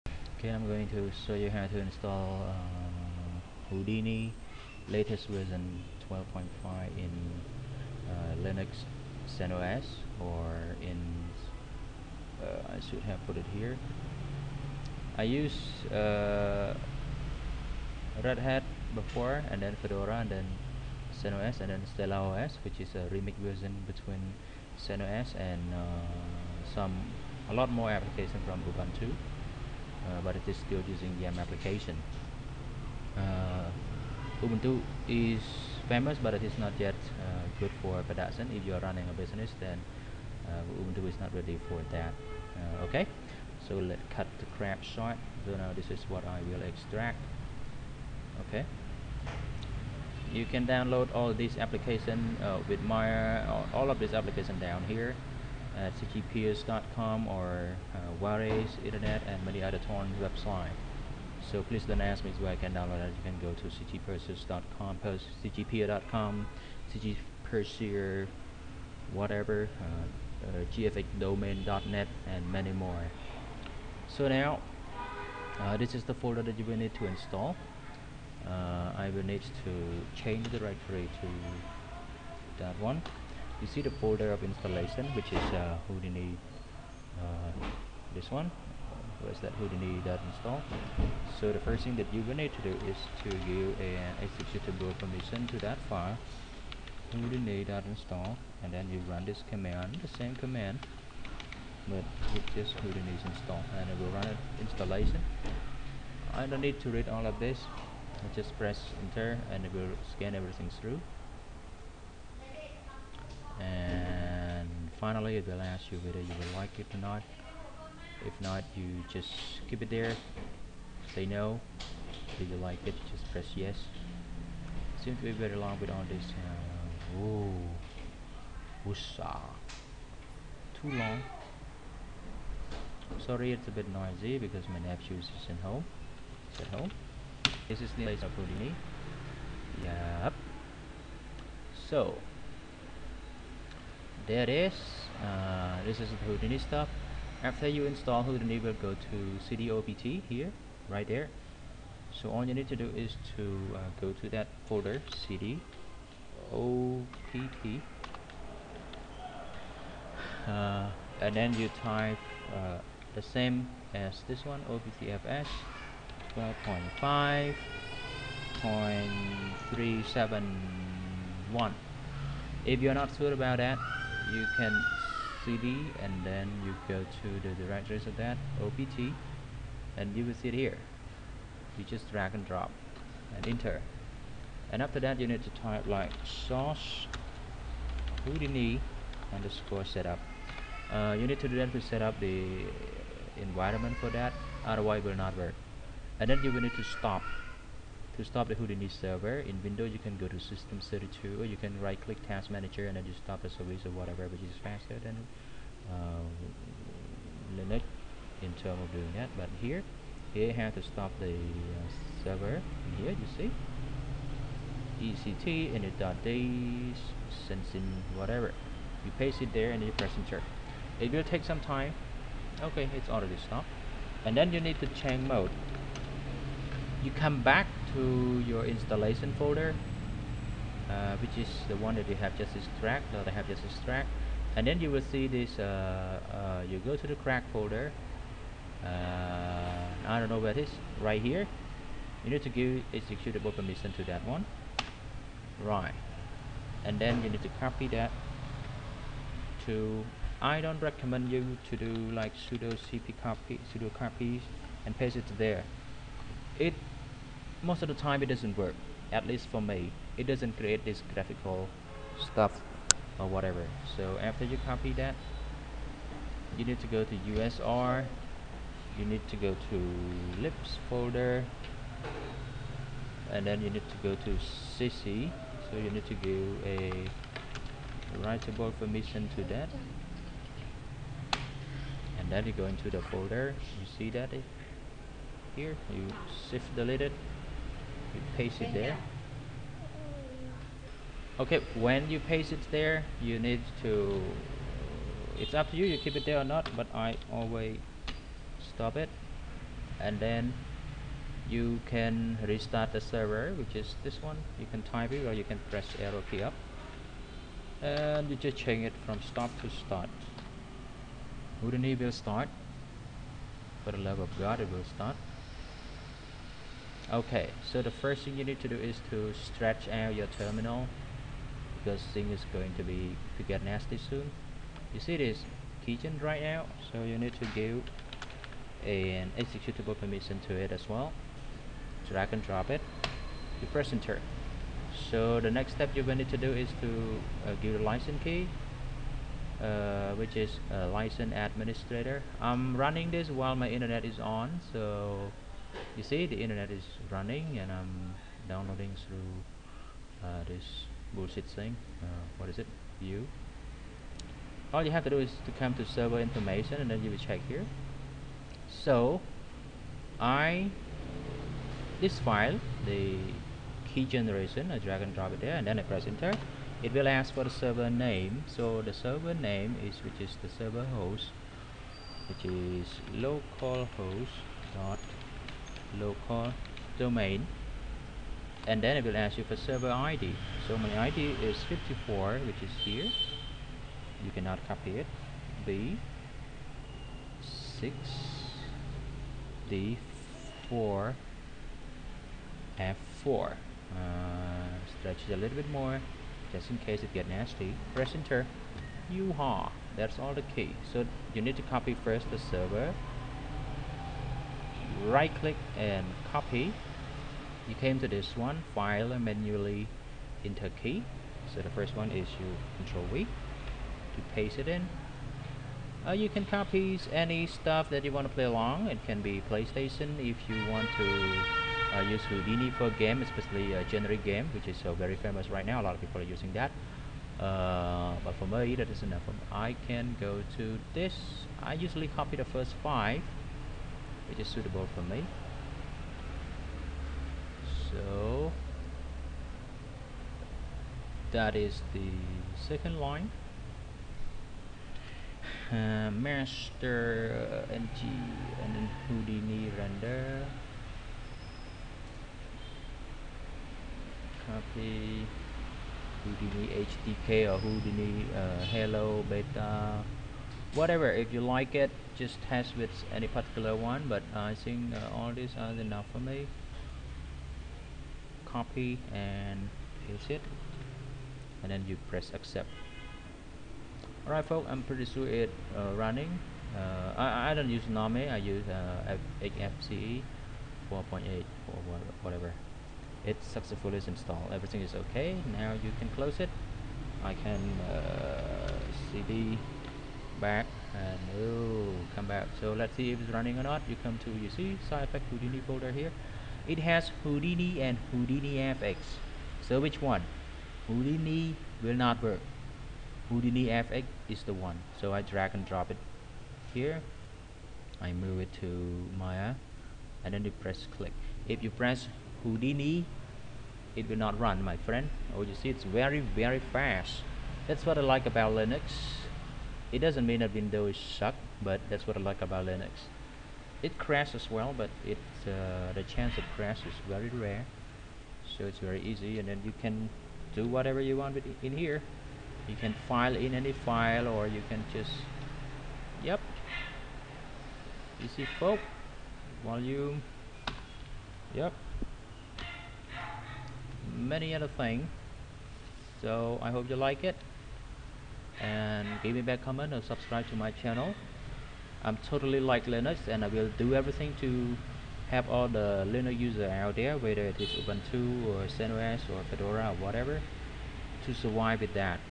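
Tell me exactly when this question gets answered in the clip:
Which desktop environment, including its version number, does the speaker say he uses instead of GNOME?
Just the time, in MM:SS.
07:59.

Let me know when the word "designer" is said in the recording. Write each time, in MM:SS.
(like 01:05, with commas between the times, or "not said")
not said.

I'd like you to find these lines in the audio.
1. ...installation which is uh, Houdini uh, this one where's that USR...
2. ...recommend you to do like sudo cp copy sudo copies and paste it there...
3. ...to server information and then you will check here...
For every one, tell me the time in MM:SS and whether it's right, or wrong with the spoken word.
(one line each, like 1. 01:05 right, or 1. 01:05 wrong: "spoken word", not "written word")
1. 01:24 wrong: "Houdini", not "USR"
2. 04:10 right
3. 05:55 right.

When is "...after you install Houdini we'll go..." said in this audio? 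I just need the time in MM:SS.
02:27.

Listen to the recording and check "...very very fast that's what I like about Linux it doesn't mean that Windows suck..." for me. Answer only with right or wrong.
right.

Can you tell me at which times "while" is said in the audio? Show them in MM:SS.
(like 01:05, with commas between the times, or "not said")
05:43.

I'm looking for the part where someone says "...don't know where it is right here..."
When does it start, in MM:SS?
04:00.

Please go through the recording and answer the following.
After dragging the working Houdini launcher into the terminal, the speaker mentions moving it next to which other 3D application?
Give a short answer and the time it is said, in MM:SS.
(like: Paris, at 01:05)
Maya, at 08:29.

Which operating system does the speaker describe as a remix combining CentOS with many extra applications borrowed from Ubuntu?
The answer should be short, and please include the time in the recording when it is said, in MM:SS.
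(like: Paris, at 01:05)
Stella OS, at 00:21.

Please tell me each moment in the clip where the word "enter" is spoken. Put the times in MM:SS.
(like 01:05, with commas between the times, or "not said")
01:49, 03:03, 03:40, 05:33, 06:06, 06:38, 06:50.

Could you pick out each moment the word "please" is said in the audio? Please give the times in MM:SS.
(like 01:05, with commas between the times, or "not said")
01:01.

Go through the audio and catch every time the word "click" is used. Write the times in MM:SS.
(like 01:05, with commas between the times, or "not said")
03:22, 06:45, 08:30.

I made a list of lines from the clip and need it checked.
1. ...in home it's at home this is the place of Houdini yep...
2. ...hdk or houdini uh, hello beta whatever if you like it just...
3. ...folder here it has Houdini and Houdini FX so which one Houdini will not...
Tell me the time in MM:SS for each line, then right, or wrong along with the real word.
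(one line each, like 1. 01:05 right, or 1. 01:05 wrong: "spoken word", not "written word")
1. 02:15 right
2. 07:36 right
3. 08:15 right.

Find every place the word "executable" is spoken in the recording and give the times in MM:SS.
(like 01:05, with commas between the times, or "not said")
01:34, 04:02, 05:29.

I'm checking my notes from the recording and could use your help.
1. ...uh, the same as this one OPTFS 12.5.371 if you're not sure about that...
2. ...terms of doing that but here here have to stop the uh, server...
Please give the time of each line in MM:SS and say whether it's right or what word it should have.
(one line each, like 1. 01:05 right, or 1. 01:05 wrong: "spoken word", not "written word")
1. 02:42 right
2. 03:28 right.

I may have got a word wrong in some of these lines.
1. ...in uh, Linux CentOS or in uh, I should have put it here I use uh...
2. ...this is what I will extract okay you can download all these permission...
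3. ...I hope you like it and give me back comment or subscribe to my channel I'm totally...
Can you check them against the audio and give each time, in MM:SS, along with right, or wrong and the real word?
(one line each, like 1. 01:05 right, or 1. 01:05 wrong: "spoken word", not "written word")
1. 00:06 right
2. 00:45 wrong: "application", not "permission"
3. 09:06 right.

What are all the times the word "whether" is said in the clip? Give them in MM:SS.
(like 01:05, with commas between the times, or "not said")
01:56, 09:17.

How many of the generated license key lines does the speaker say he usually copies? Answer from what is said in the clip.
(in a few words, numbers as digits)
The first 5.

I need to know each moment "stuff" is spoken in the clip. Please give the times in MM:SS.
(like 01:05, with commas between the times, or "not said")
02:26, 04:22, 06:57.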